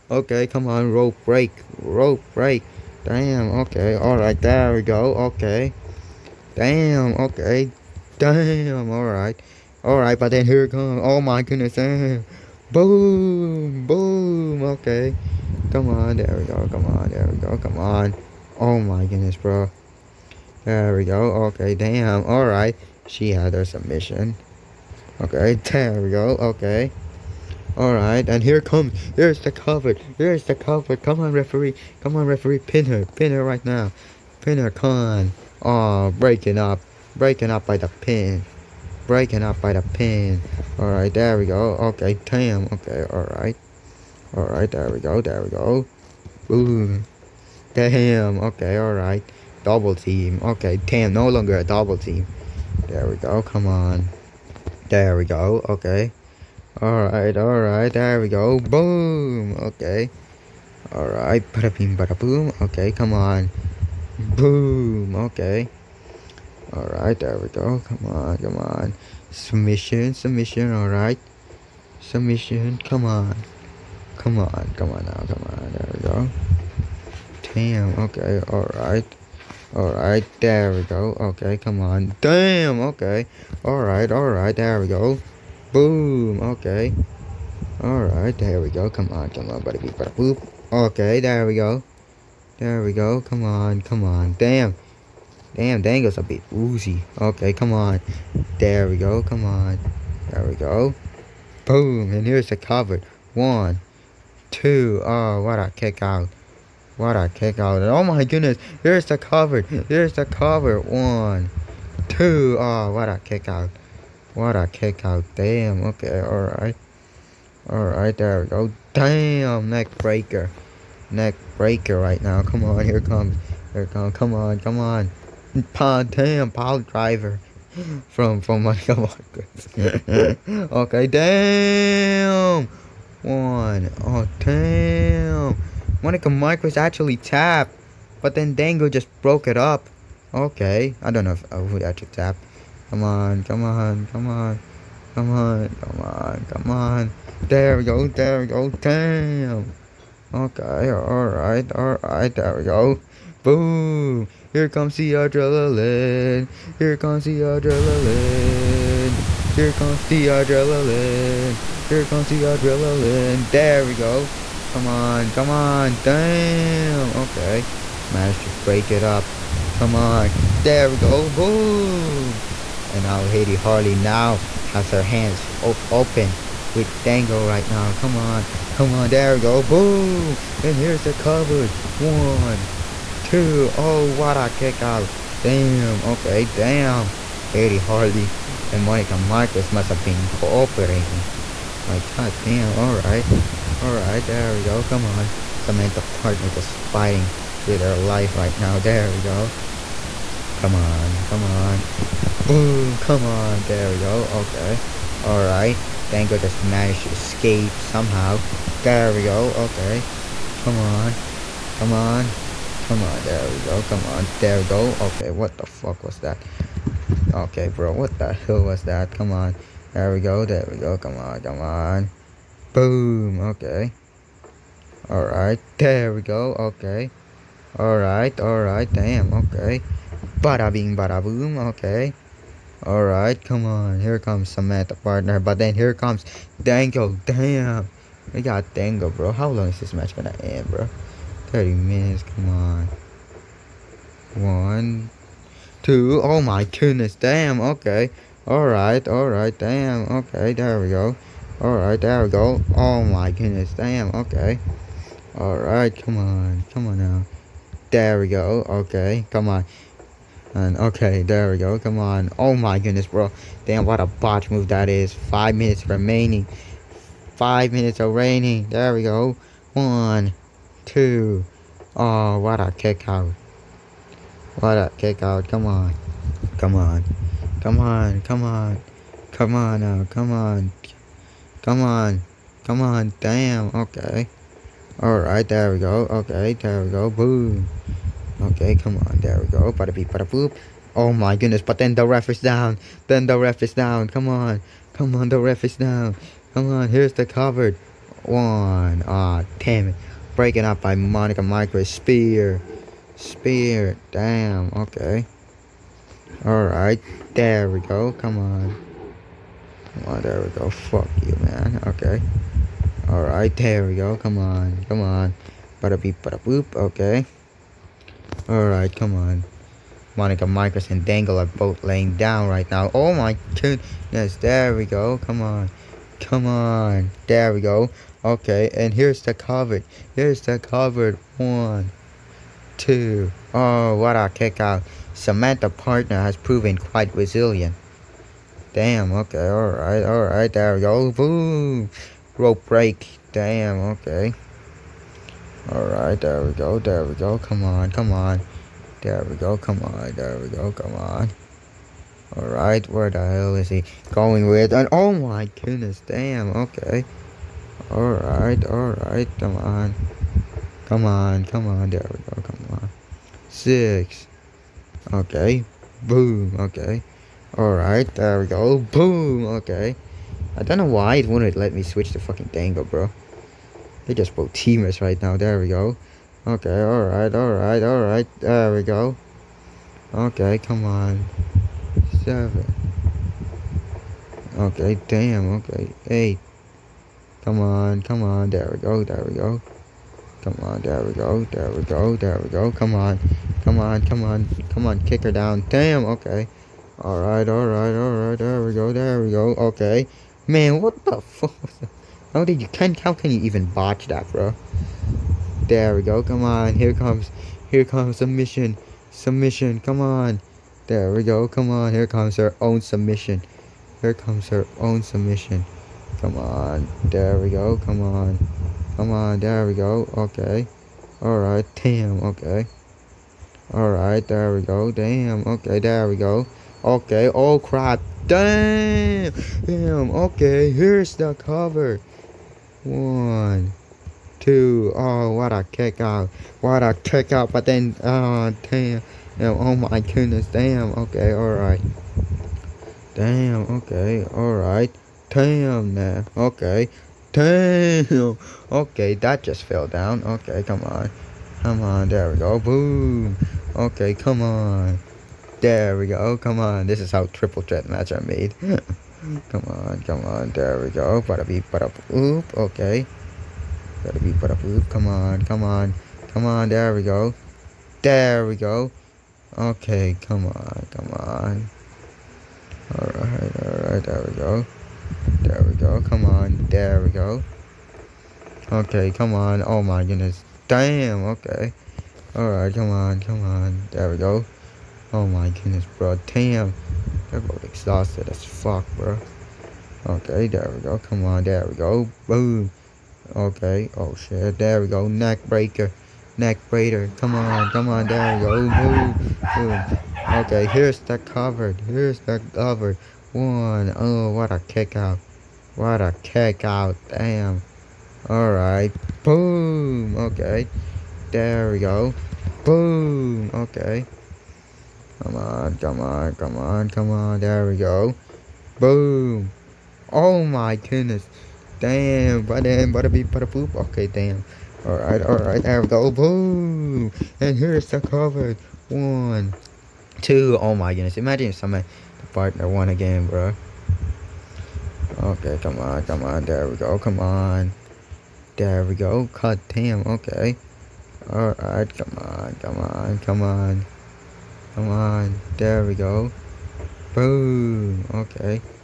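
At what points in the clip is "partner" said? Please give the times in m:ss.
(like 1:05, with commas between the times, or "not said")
3:16, 3:54, 5:35, 8:52.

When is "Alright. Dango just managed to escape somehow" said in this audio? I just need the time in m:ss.
3:25.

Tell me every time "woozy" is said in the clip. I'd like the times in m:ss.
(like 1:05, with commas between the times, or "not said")
1:36.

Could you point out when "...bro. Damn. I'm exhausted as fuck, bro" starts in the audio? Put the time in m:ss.
8:05.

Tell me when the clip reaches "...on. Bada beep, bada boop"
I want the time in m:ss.
5:15.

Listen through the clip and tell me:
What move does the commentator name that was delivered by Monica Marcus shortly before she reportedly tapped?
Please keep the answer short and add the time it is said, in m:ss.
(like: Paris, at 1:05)
Power driver, at 2:06.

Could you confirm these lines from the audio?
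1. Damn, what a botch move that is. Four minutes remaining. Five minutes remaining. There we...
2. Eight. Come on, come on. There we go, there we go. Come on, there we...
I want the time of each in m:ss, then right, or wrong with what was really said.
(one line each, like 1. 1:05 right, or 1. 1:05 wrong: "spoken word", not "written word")
1. 4:23 wrong: "Five", not "Four"
2. 6:26 right.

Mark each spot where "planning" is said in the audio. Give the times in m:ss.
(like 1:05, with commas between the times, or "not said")
not said.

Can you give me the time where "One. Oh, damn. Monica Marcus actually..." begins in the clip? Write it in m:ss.
2:13.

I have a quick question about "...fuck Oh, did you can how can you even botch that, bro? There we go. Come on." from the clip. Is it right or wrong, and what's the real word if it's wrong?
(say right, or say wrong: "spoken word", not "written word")
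right.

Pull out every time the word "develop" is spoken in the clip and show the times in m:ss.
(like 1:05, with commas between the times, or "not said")
not said.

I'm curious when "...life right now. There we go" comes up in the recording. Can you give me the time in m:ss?
3:17.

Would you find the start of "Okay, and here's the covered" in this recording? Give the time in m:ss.
5:28.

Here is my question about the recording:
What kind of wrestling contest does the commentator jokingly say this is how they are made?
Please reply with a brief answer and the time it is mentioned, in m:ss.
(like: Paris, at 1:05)
Triple threat match, at 7:37.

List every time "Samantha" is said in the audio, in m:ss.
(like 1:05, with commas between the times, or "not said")
3:15, 3:54, 5:35.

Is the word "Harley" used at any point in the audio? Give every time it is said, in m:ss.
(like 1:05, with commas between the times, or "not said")
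2:53, 3:07.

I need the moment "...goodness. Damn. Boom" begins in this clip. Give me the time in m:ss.
0:11.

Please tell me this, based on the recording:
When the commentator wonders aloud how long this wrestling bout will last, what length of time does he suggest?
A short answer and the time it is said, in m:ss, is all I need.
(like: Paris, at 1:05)
30 minutes, at 4:01.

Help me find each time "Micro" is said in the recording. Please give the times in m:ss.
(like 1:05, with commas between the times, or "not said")
5:01, 5:20.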